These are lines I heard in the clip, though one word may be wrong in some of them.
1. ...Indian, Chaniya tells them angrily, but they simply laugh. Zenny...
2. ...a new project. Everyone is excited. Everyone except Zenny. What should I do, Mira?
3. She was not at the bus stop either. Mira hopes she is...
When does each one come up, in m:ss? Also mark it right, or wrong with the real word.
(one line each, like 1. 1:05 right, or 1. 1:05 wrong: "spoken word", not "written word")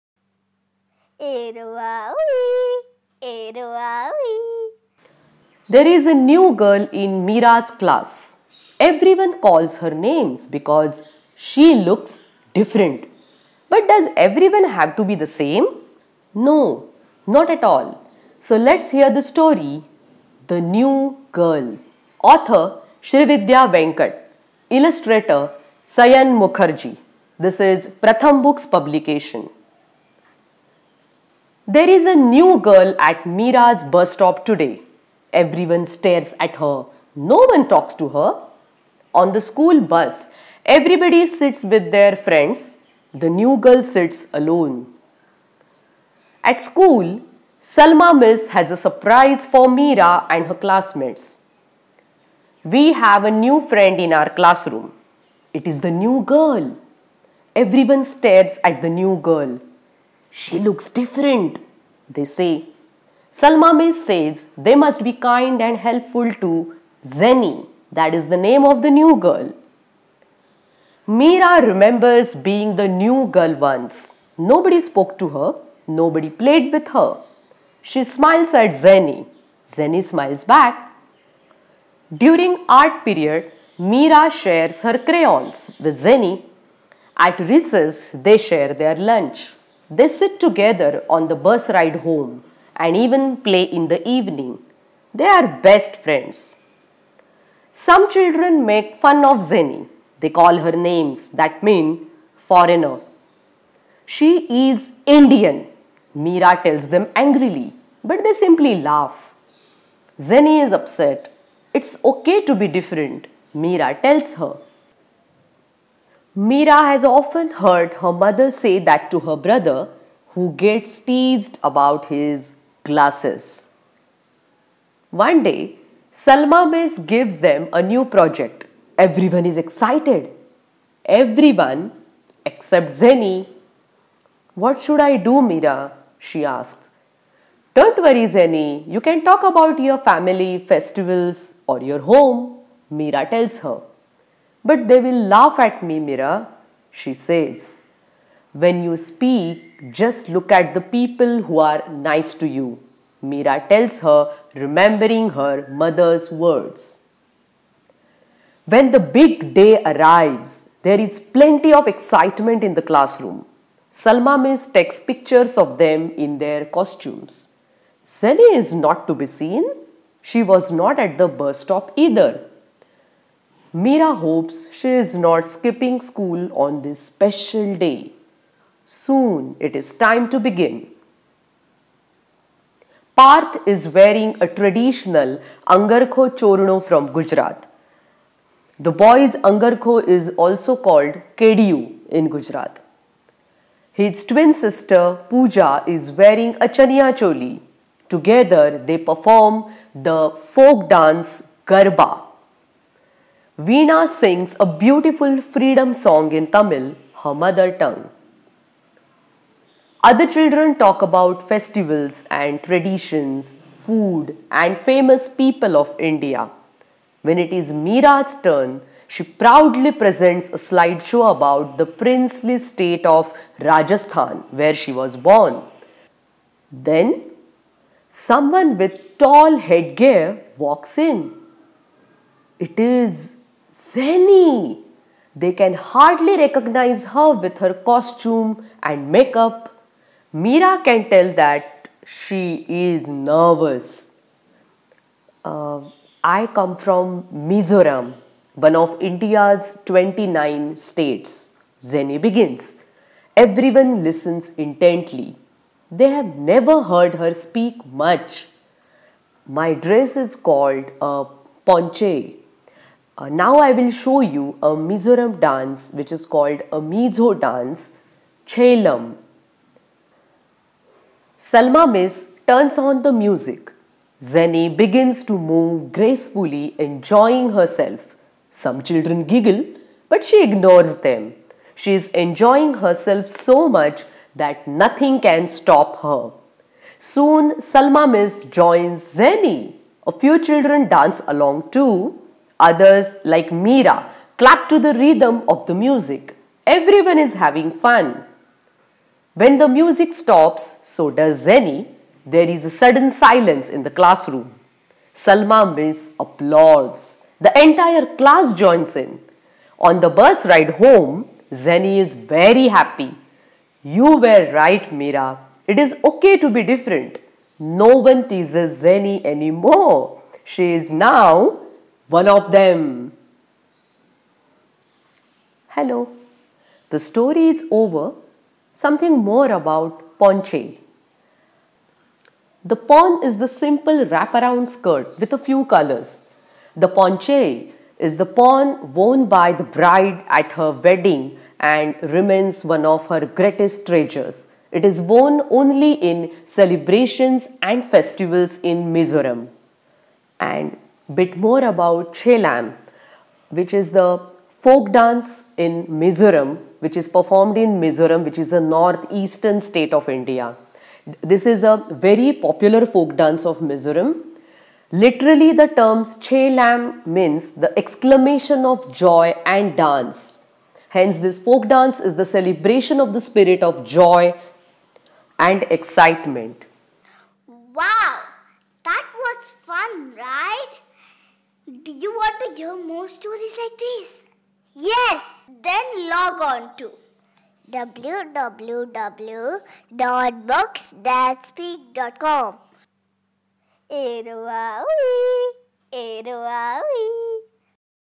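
1. 1:45 wrong: "Mira", not "Chaniya"
2. 2:07 right
3. 2:50 right.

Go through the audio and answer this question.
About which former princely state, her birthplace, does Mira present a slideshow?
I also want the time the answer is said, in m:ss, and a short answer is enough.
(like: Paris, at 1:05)
Rajasthan, at 3:43.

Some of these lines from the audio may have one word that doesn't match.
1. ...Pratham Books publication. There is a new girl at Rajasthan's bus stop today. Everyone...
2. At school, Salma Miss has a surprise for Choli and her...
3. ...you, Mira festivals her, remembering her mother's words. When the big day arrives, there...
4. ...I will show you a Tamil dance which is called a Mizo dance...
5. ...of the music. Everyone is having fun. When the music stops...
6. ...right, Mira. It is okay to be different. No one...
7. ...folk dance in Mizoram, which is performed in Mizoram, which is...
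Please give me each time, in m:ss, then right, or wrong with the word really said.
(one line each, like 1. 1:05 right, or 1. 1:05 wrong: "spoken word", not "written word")
1. 0:27 wrong: "Mira", not "Rajasthan"
2. 0:46 wrong: "Mira", not "Choli"
3. 2:32 wrong: "tells", not "festivals"
4. 4:23 wrong: "Mizoram", not "Tamil"
5. 4:55 right
6. 5:14 right
7. 5:54 right.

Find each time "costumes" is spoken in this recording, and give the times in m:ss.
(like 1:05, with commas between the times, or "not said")
2:46, 3:57.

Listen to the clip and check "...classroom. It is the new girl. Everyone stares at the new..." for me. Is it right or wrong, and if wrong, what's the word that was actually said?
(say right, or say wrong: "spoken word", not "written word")
right.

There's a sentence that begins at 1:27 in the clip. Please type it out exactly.
At recess, they share their lunch.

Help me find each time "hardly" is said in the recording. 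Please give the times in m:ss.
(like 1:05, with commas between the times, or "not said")
3:55.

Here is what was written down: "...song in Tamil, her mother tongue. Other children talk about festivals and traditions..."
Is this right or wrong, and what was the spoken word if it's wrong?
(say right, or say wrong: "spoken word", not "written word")
right.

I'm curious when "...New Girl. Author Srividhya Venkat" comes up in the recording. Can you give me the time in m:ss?
0:20.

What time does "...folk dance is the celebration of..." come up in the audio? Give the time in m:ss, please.
6:11.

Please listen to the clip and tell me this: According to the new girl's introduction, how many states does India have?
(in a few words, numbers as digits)
29.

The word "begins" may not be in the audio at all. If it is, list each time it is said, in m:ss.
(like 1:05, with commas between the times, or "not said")
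3:00, 4:12, 4:34.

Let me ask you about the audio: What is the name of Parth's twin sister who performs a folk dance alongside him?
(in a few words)
Pooja.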